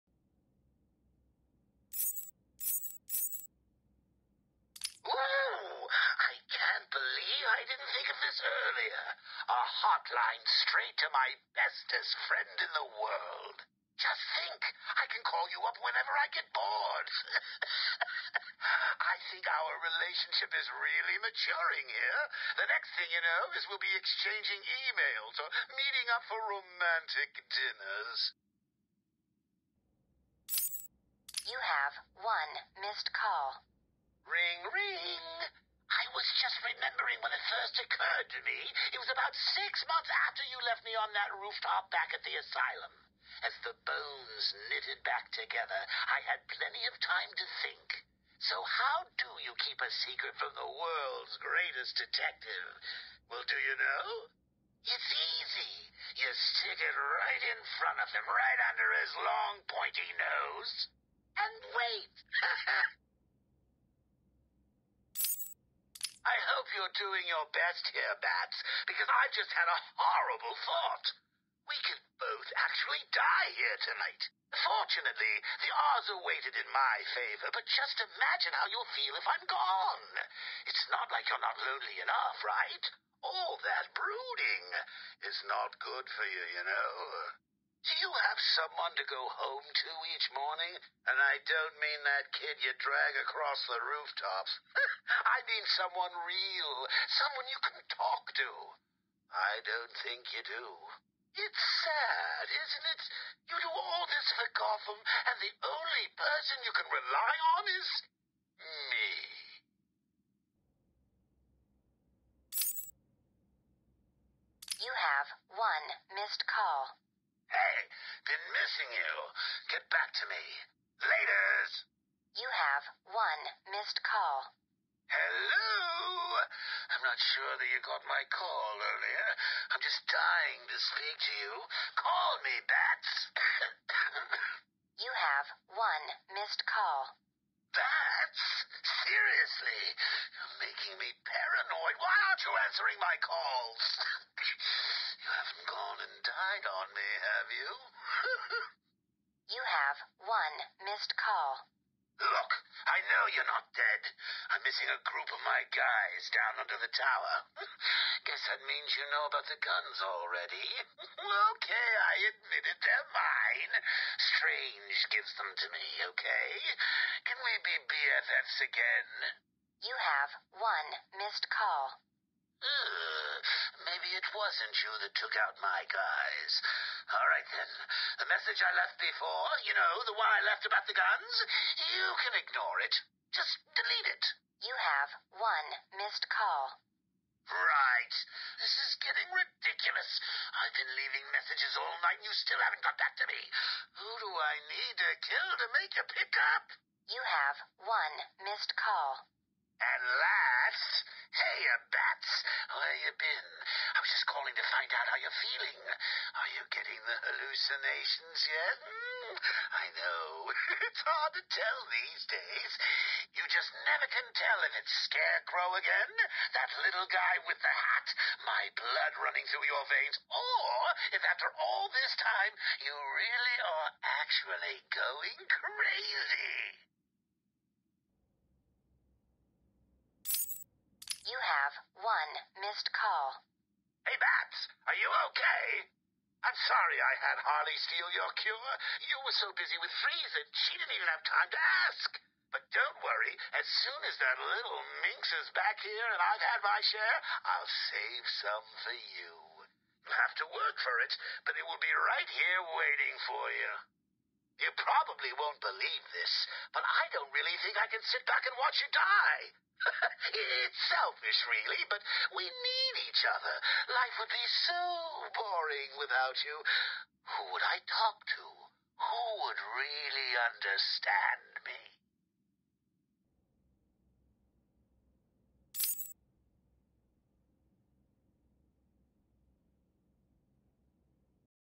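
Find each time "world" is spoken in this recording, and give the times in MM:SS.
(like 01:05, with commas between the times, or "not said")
00:12, 00:50.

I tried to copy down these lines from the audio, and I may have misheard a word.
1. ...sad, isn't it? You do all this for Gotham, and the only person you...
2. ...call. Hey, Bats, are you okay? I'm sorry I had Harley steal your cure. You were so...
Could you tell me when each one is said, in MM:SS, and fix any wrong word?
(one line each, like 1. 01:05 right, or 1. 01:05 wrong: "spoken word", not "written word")
1. 01:41 right
2. 03:52 right.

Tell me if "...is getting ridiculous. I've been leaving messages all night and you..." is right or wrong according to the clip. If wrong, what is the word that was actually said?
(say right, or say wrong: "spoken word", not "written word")
right.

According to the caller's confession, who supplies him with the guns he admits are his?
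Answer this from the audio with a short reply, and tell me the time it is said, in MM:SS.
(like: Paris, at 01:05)
Strange, at 02:44.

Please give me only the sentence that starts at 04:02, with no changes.
But don't worry, as soon as that little minx is back here and I've had my share, I'll save some for you.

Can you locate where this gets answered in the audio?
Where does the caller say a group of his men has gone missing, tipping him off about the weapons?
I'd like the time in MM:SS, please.
02:36.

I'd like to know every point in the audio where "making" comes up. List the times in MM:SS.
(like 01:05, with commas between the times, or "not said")
02:20.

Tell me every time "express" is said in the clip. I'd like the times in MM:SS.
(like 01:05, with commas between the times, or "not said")
not said.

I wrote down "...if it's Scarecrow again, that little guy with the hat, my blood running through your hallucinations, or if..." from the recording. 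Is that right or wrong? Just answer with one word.
wrong.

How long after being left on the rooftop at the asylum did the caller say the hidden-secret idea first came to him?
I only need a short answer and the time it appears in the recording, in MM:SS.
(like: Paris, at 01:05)
6 months, at 00:39.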